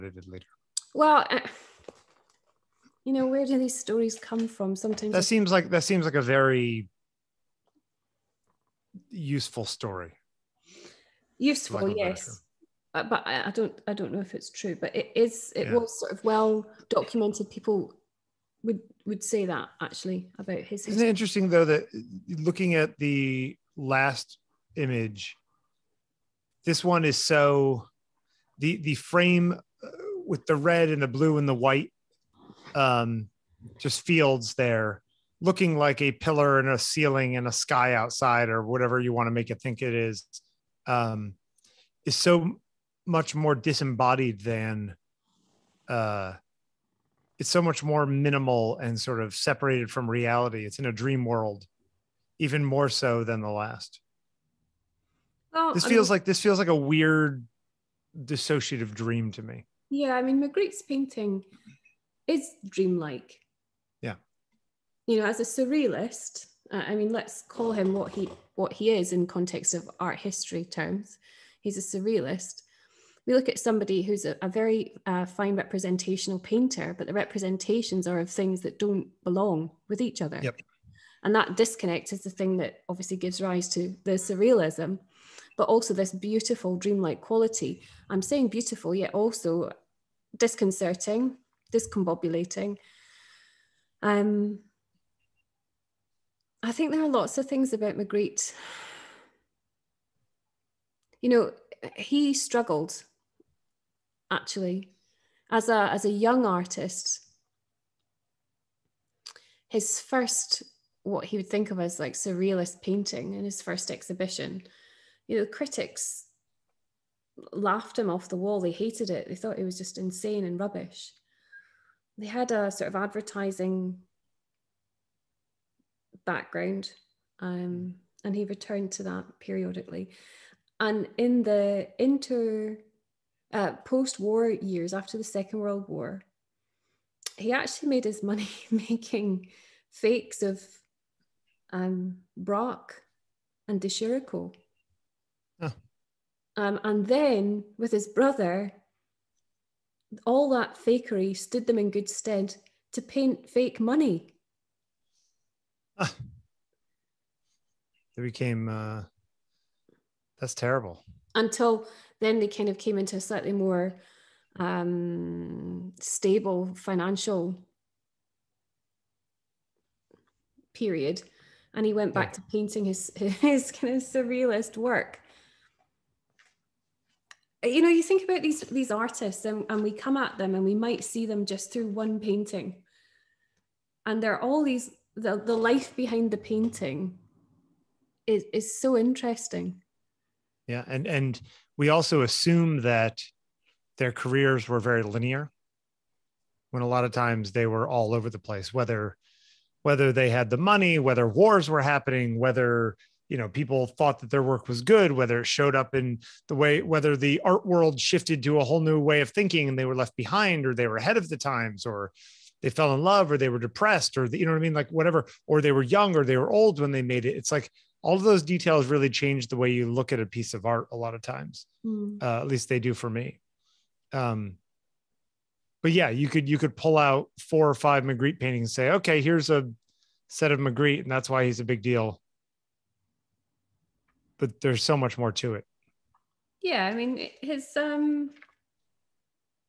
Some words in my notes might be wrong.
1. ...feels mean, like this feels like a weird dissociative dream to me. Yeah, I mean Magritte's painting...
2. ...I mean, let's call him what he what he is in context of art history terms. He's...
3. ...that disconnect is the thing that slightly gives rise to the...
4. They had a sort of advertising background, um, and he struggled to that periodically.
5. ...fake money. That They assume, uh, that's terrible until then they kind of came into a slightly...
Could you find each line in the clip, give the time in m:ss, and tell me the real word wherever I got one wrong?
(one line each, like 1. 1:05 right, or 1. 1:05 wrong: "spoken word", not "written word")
1. 0:55 right
2. 1:06 right
3. 1:21 wrong: "obviously", not "slightly"
4. 2:02 wrong: "returned", not "struggled"
5. 2:33 wrong: "became", not "assume".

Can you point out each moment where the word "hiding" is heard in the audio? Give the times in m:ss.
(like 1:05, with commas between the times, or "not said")
not said.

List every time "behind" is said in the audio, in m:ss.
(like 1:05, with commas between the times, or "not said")
3:05, 3:30.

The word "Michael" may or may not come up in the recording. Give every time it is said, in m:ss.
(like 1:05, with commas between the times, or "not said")
not said.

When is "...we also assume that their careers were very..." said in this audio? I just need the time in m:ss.
3:11.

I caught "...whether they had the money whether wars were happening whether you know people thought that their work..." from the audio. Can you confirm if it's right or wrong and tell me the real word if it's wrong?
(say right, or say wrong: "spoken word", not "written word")
right.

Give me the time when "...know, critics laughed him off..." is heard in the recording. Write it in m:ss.
1:55.